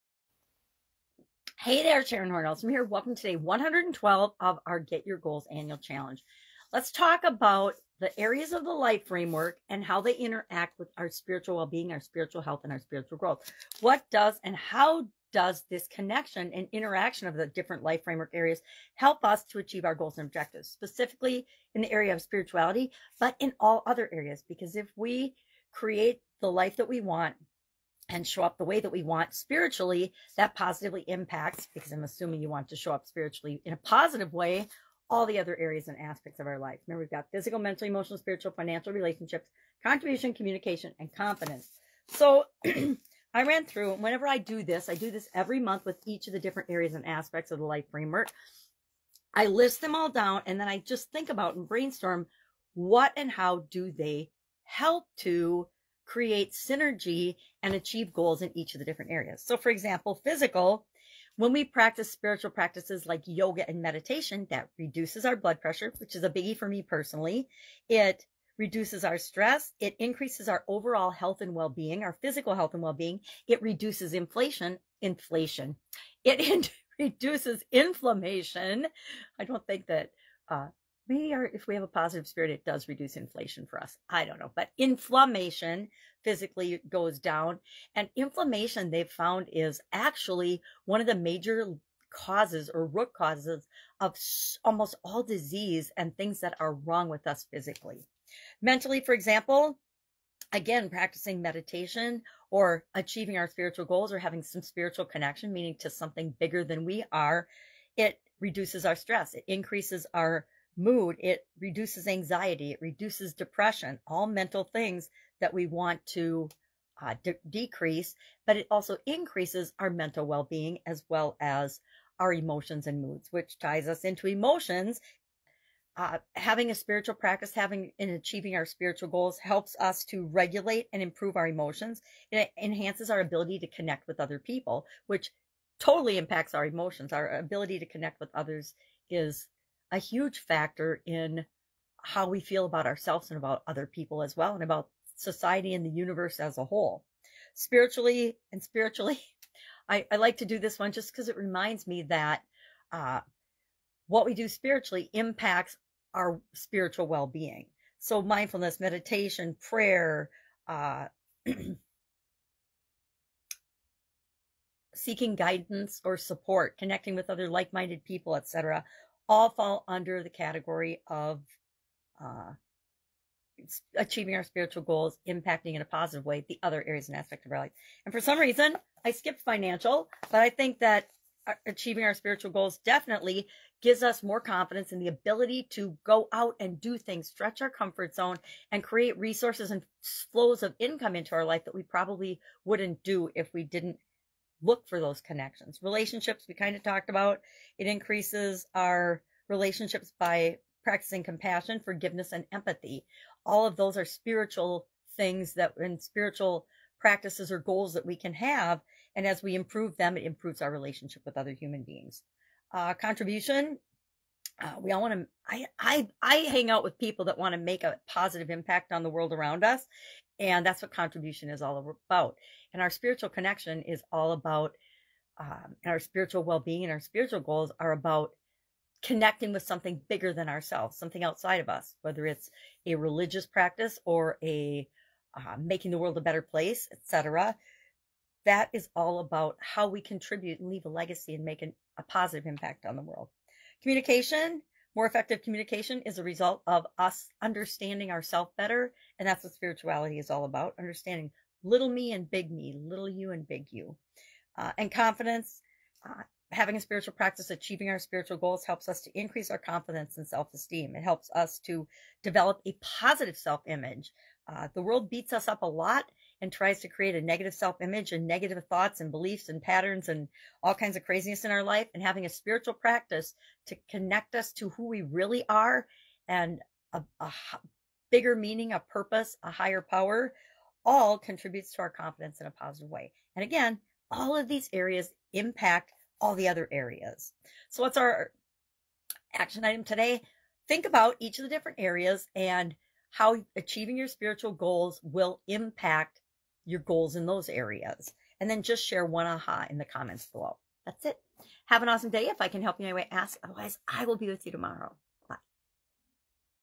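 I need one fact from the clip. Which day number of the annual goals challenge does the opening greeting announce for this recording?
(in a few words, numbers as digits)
112.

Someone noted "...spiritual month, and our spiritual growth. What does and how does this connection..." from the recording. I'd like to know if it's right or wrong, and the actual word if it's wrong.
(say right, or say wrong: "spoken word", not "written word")
wrong: "health", not "month".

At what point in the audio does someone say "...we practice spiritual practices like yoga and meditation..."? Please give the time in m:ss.
1:01.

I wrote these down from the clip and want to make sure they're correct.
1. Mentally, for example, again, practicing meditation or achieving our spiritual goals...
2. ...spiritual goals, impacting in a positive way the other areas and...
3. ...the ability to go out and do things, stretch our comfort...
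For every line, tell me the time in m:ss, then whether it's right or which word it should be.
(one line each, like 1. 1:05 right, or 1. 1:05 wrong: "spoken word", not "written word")
1. 1:38 right
2. 2:54 right
3. 3:04 right.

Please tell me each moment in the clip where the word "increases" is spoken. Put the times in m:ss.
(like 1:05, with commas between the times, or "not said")
1:09, 1:49, 1:59, 3:17, 4:19.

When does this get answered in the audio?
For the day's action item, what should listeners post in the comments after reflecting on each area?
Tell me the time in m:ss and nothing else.
4:59.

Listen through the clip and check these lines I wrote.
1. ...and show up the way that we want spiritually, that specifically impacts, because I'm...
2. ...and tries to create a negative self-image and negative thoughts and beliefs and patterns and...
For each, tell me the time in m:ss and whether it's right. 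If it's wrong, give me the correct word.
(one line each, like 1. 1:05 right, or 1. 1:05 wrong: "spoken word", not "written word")
1. 0:28 wrong: "positively", not "specifically"
2. 4:26 right.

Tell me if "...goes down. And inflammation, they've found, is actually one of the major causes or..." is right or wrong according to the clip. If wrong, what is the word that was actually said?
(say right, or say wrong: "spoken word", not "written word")
right.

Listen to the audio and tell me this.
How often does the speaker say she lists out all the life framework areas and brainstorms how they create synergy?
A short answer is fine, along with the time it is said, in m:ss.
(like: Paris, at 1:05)
Every month, at 0:45.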